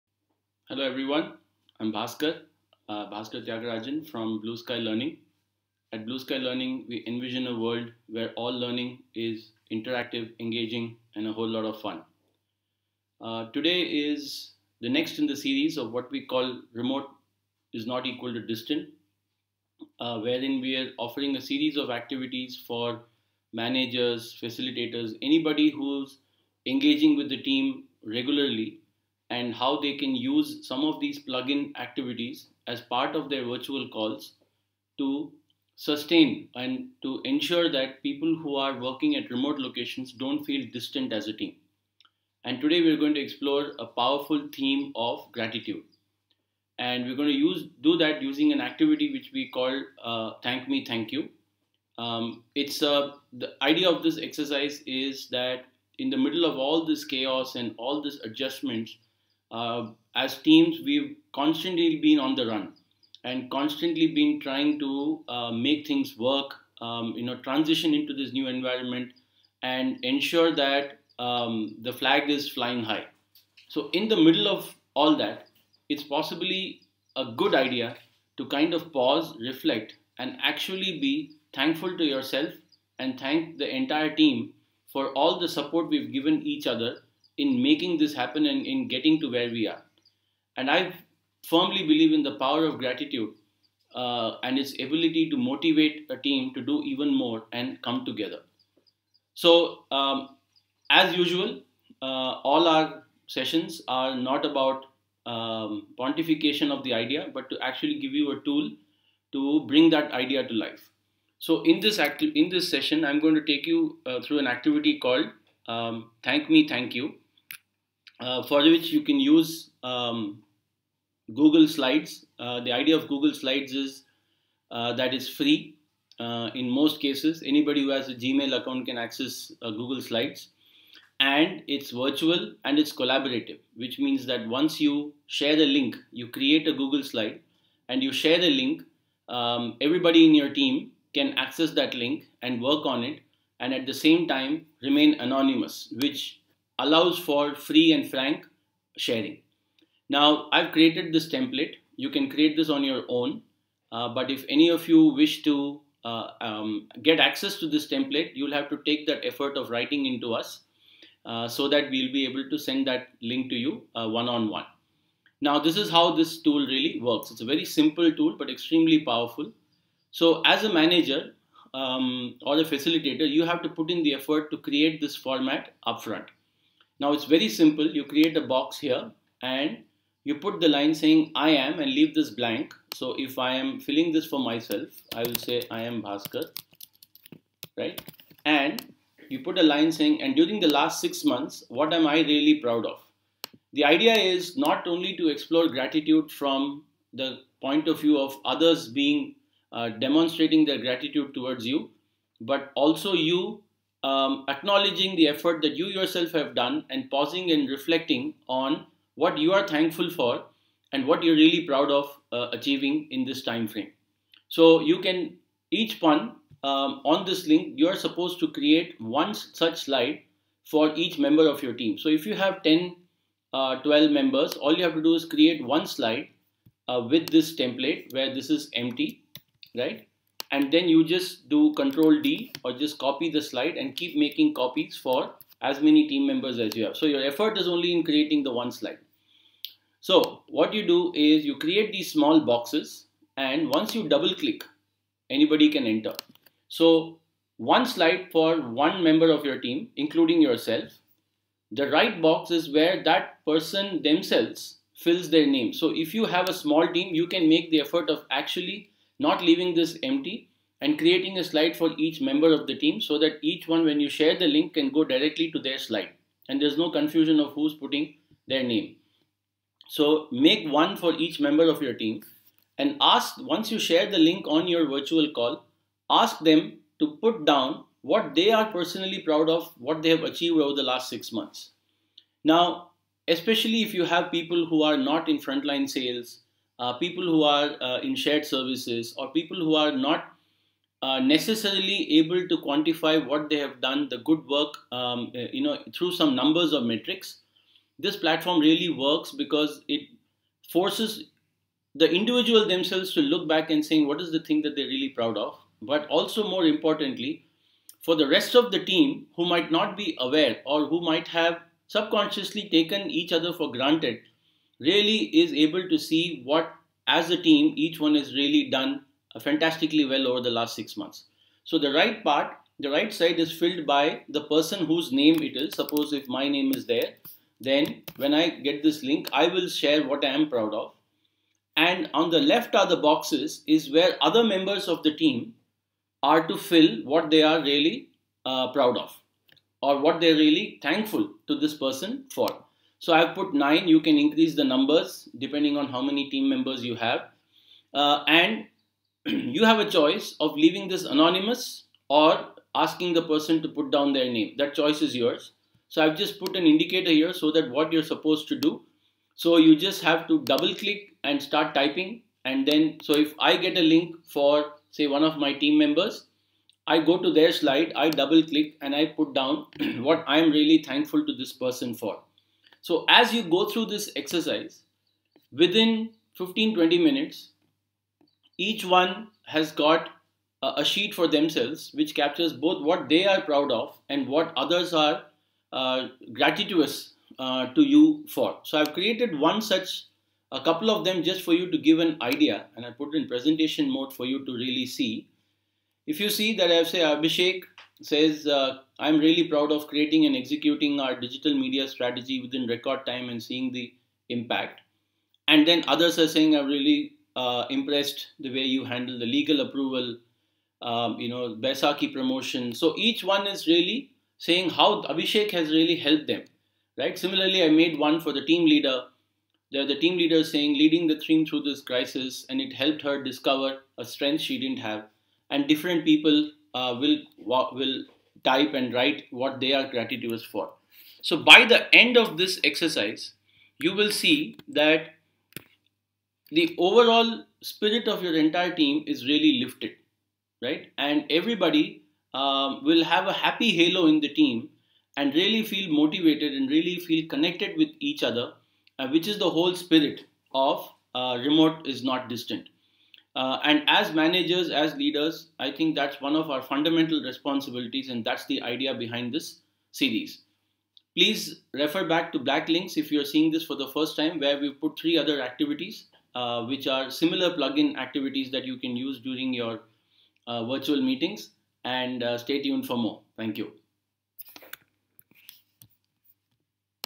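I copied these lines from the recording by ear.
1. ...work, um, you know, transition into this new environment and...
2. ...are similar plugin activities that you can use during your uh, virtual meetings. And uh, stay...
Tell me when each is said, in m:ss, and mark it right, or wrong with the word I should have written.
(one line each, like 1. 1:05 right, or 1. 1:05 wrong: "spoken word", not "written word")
1. 1:06 right
2. 7:46 right.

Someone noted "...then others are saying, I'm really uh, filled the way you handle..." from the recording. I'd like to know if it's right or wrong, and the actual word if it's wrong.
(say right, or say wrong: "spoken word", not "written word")
wrong: "impressed", not "filled".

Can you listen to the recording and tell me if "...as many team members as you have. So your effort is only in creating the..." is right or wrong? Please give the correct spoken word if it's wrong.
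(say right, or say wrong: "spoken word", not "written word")
right.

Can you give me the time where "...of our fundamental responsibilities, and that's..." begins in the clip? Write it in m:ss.
7:36.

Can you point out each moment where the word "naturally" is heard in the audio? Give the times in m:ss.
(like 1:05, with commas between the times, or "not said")
not said.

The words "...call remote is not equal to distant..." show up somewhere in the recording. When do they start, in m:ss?
0:16.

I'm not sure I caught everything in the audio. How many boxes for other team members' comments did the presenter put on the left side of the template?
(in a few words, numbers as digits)
9.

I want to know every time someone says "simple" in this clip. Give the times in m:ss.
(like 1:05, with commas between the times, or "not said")
2:47, 2:57.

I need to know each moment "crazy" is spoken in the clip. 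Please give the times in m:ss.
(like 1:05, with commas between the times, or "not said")
not said.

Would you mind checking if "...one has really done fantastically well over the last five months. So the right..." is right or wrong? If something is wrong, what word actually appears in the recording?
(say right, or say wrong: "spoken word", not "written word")
wrong: "six", not "five".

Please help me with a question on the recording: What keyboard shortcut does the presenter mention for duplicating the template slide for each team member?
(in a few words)
Control D.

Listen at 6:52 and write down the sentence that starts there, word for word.
So each one is really saying how Abhishek has really helped them, right?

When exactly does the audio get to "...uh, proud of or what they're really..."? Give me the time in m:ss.
5:38.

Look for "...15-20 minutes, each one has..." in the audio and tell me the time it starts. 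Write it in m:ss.
6:16.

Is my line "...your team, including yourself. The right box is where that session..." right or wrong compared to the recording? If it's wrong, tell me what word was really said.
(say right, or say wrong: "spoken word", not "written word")
wrong: "person", not "session".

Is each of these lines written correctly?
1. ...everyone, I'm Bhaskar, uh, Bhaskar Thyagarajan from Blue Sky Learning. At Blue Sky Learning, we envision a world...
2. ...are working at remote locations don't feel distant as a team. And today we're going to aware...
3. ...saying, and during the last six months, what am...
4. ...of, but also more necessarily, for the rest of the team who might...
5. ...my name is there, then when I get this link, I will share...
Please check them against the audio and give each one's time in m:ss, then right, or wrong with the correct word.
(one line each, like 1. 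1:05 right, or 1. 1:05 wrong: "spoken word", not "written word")
1. 0:00 right
2. 0:38 wrong: "explore", not "aware"
3. 3:09 right
4. 5:05 wrong: "importantly", not "necessarily"
5. 5:26 right.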